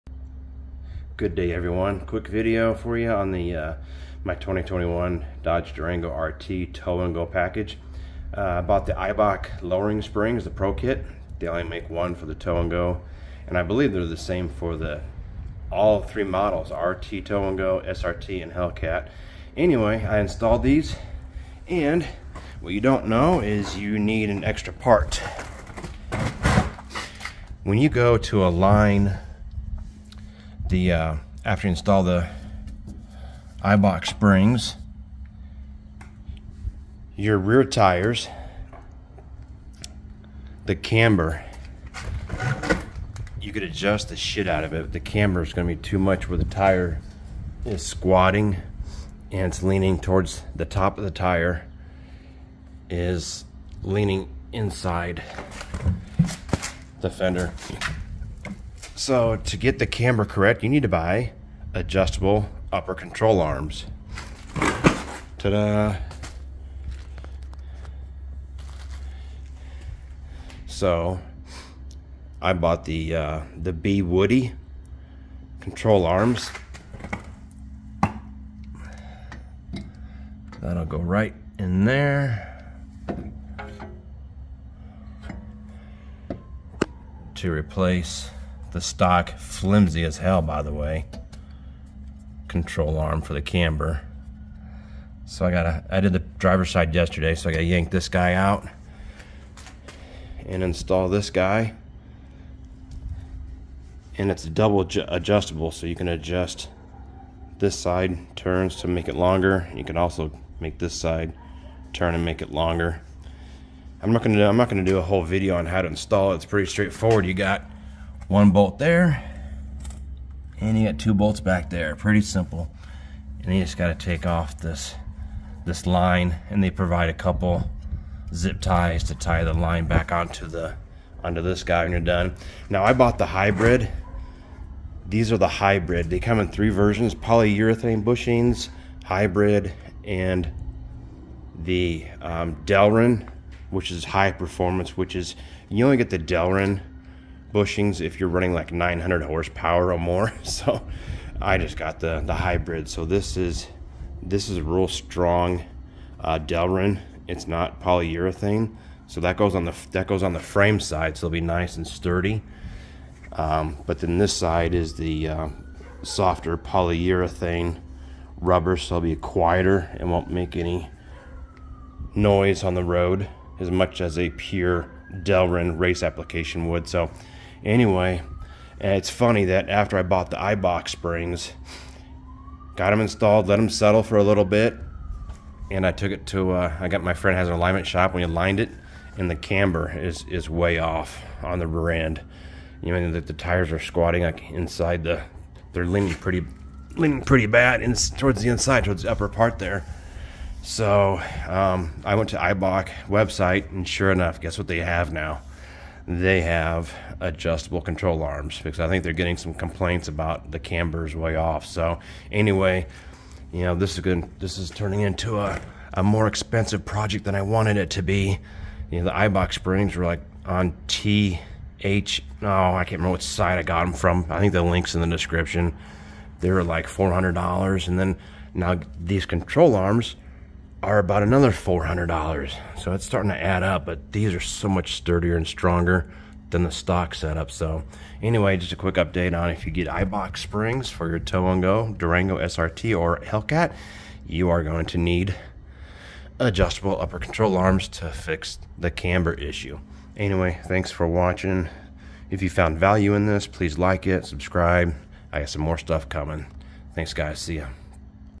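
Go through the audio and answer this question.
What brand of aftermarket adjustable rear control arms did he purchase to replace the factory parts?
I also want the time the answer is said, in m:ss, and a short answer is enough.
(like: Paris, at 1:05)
BWoody, at 1:13.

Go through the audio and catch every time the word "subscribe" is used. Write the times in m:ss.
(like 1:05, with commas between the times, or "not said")
4:14.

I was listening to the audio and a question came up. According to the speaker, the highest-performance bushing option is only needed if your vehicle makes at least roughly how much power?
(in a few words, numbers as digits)
900 horsepower.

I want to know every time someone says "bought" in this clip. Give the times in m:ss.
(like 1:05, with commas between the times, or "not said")
0:08, 1:12, 2:12, 3:00.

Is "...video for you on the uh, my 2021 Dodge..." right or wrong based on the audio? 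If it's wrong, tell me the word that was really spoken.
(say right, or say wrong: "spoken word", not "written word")
right.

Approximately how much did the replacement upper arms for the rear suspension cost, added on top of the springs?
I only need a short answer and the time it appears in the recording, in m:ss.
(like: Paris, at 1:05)
$400, at 3:51.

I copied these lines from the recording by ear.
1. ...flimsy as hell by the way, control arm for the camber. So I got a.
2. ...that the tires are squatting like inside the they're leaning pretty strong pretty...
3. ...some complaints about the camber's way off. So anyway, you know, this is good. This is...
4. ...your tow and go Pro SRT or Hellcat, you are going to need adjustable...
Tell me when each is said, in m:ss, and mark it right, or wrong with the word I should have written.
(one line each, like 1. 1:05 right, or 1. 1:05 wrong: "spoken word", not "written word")
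1. 1:29 right
2. 3:13 wrong: "leaning", not "strong"
3. 3:29 right
4. 4:01 wrong: "Durango", not "Pro".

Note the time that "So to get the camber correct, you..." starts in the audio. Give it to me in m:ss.
0:59.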